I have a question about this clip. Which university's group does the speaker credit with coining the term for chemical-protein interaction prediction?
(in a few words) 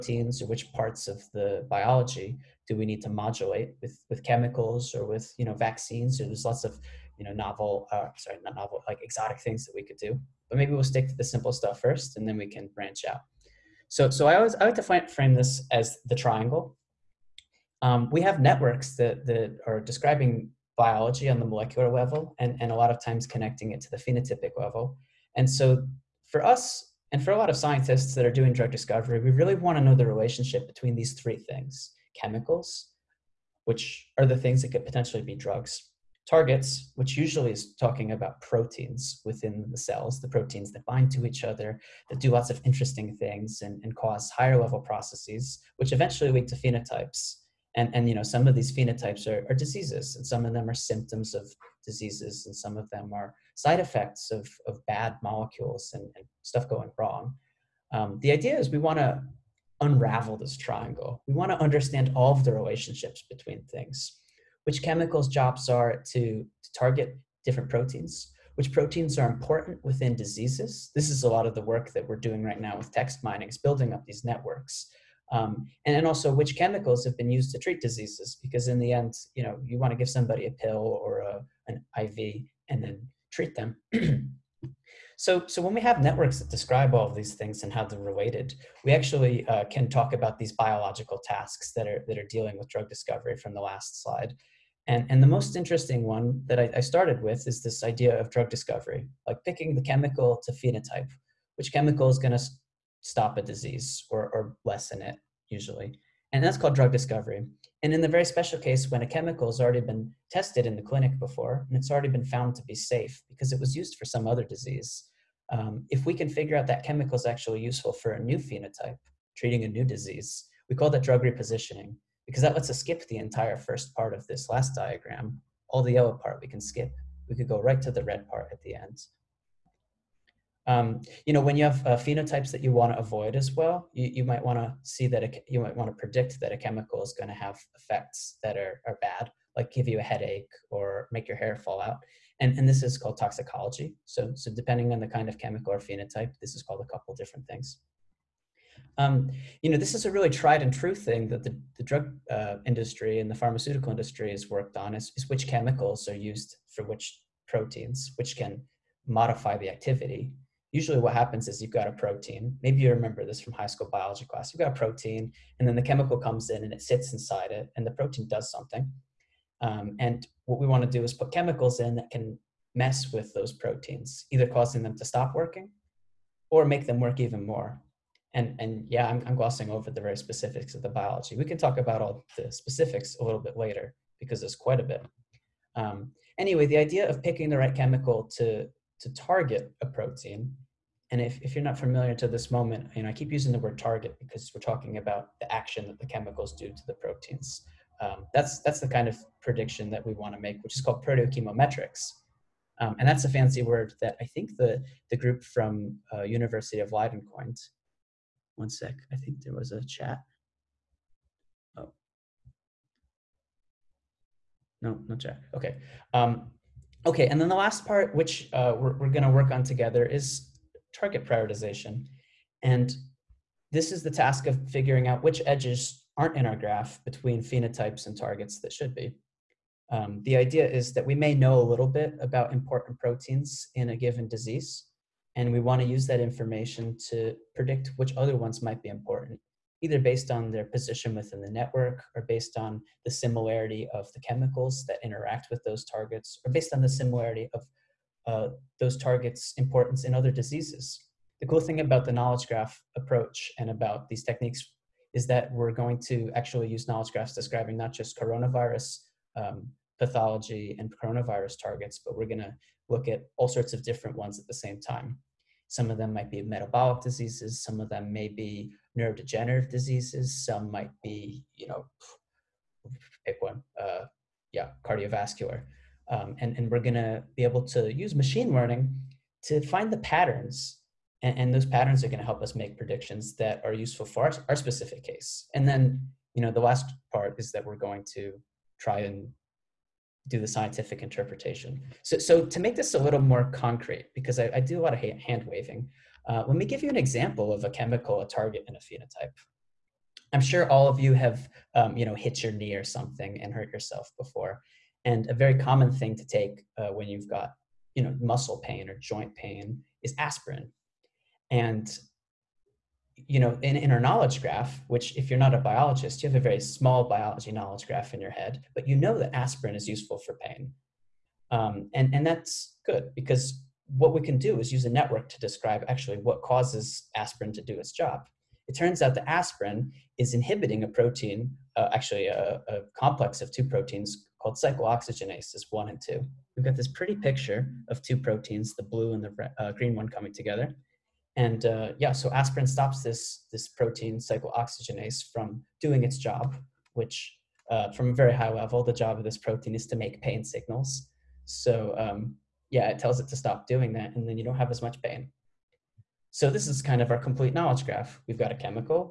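University of Leiden.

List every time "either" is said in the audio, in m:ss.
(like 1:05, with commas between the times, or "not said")
2:54, 3:59.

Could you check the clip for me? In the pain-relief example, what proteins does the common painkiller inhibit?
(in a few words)
Cyclooxygenases 1 and 2.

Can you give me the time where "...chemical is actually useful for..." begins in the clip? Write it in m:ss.
1:56.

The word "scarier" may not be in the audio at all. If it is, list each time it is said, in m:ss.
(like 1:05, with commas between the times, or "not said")
not said.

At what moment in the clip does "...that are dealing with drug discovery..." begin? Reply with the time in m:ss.
1:32.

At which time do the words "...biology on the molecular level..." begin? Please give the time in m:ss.
0:20.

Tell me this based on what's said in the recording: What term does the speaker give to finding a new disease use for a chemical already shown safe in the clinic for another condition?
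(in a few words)
Drug repositioning.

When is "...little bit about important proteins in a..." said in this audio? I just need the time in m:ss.
3:51.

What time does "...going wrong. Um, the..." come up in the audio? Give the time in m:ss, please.
0:56.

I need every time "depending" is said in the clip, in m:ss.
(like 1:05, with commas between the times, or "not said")
2:24.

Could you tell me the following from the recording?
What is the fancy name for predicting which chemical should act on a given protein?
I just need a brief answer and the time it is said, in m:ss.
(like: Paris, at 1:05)
Proteochemometrics, at 3:21.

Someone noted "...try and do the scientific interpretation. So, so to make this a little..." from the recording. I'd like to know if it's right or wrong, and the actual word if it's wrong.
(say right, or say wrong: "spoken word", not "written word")
right.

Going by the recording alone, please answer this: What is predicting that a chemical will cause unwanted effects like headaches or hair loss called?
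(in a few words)
Toxicology.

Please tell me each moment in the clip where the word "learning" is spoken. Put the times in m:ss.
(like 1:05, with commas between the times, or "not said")
4:38.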